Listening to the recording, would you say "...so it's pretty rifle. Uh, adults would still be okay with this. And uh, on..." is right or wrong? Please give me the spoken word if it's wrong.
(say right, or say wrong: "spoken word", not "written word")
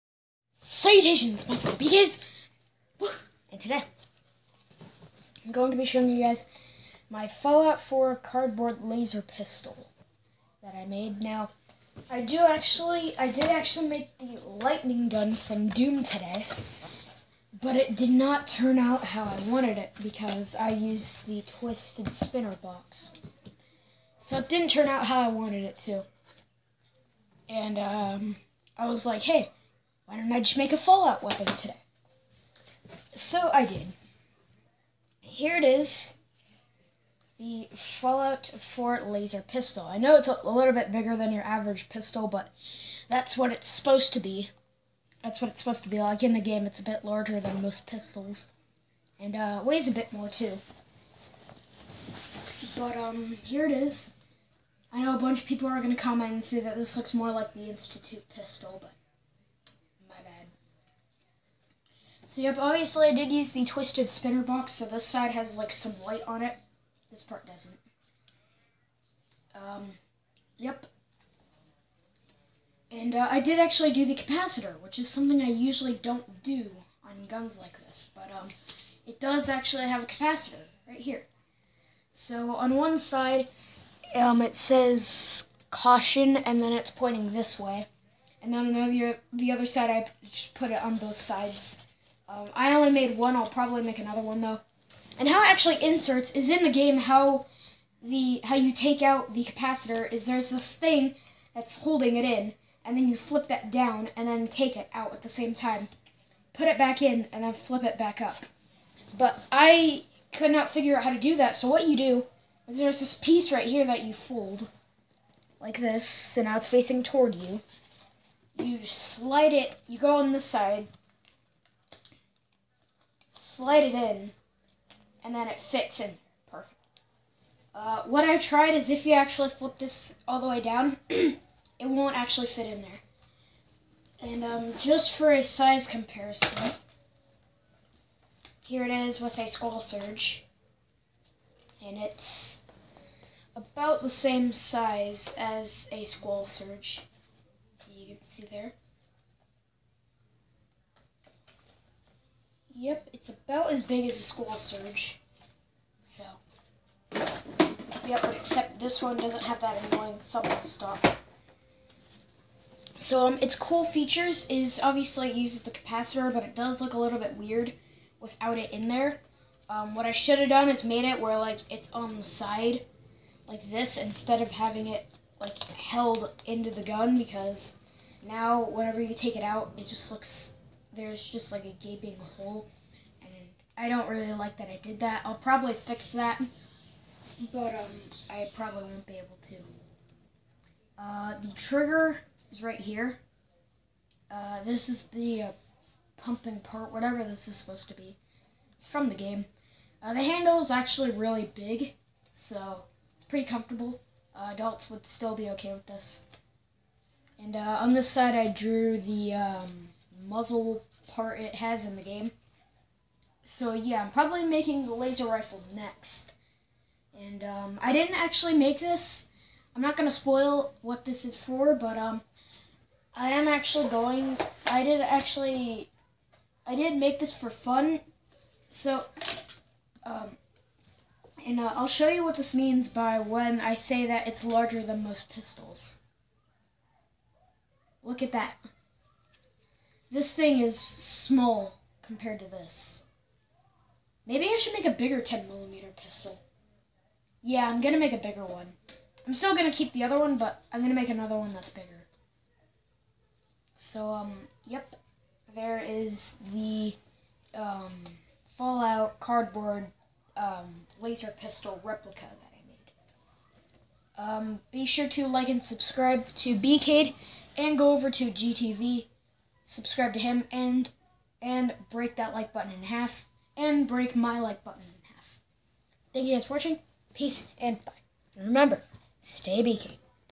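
wrong: "comfortable", not "rifle".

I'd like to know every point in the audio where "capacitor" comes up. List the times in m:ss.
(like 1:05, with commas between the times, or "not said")
1:14, 1:20, 1:39, 2:45.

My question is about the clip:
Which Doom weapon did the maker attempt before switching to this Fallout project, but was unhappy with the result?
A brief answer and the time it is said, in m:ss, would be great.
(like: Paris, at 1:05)
lightning gun, at 0:14.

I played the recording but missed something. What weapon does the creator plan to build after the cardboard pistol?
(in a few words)
laser rifle.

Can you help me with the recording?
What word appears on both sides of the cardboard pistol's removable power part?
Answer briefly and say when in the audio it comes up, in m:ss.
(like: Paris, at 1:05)
caution, at 1:25.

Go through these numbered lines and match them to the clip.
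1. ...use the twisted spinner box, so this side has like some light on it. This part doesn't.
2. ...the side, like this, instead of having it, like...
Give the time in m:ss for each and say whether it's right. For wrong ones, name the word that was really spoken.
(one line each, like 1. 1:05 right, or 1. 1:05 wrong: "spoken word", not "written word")
1. 1:03 right
2. 2:52 right.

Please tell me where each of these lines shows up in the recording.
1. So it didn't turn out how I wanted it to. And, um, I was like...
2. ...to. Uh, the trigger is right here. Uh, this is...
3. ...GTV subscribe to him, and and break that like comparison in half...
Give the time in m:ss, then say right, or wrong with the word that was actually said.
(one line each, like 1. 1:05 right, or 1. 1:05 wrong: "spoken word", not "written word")
1. 0:24 right
2. 3:09 right
3. 4:28 wrong: "button", not "comparison".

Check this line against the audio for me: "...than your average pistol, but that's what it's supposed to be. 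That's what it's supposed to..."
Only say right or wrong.
right.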